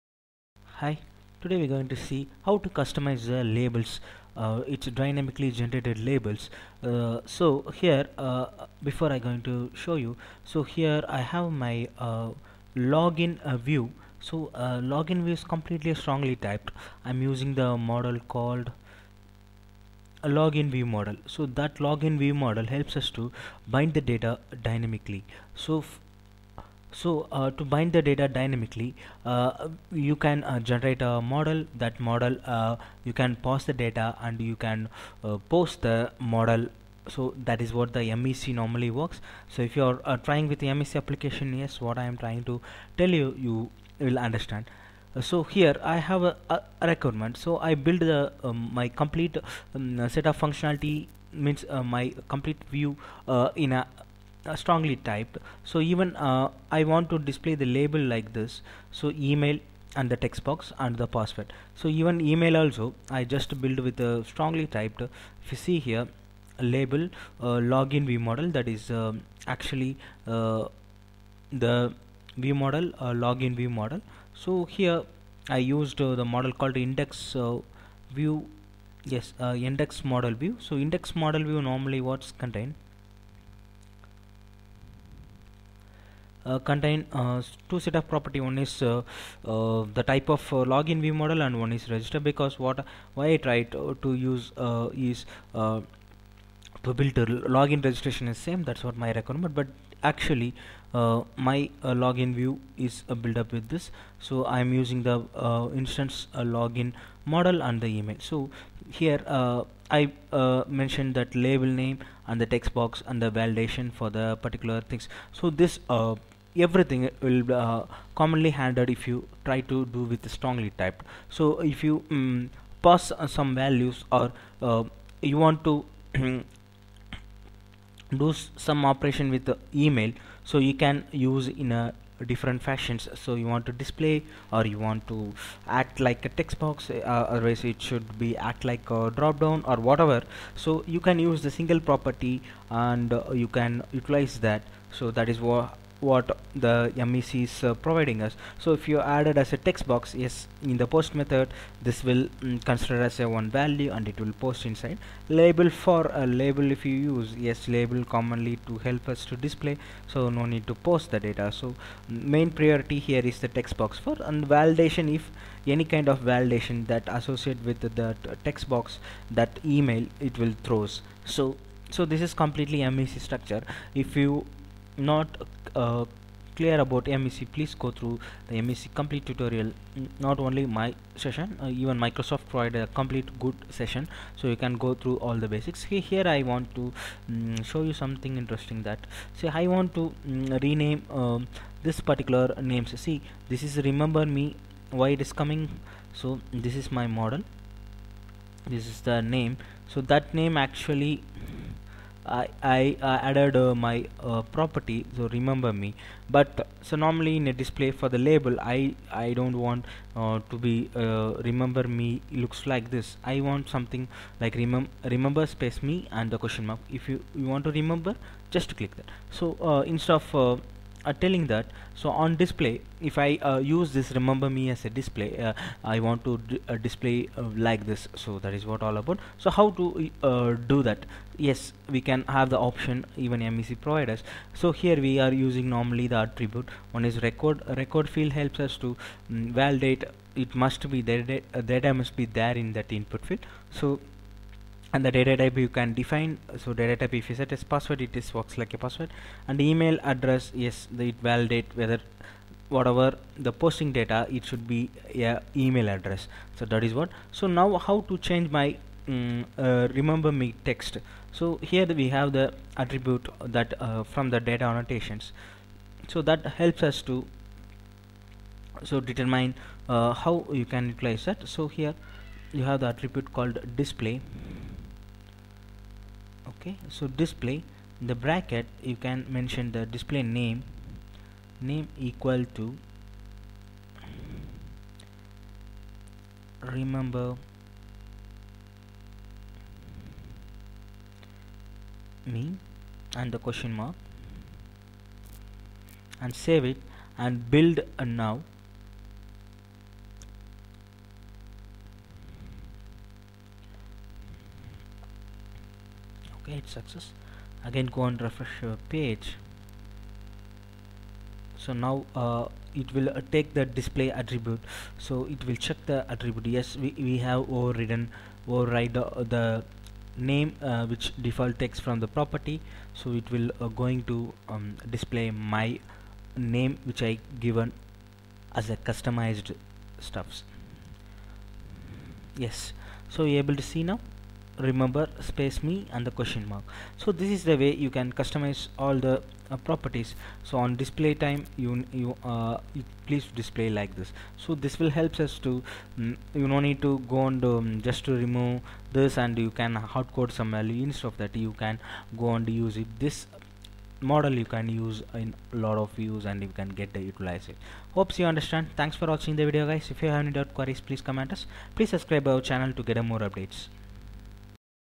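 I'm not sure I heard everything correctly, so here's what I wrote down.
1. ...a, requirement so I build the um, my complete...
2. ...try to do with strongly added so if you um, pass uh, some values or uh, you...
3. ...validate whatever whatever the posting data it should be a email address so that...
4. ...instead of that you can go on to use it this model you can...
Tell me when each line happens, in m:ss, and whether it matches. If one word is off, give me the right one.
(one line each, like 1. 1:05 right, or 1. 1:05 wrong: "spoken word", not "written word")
1. 0:46 right
2. 1:59 wrong: "typed", not "added"
3. 4:11 wrong: "whether", not "whatever"
4. 5:50 right.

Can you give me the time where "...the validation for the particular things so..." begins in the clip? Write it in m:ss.
1:53.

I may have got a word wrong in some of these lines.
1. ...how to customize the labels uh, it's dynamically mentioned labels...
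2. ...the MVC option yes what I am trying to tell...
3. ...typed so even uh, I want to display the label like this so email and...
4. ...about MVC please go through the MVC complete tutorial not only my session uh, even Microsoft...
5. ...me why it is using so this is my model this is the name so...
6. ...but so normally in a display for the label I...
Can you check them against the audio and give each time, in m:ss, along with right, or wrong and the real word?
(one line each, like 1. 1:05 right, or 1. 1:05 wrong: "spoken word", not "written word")
1. 0:02 wrong: "generated", not "mentioned"
2. 0:40 wrong: "application", not "option"
3. 0:54 right
4. 2:56 right
5. 3:14 wrong: "coming", not "using"
6. 3:26 right.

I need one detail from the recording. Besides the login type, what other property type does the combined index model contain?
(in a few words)
register.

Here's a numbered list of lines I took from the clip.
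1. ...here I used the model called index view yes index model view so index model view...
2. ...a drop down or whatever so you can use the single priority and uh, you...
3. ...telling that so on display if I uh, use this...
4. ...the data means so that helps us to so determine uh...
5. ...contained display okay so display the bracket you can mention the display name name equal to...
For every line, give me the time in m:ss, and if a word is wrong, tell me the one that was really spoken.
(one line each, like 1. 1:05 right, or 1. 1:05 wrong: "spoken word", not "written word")
1. 1:14 right
2. 2:18 wrong: "property", not "priority"
3. 3:41 right
4. 4:24 wrong: "annotations", not "means"
5. 4:33 wrong: "called", not "contained".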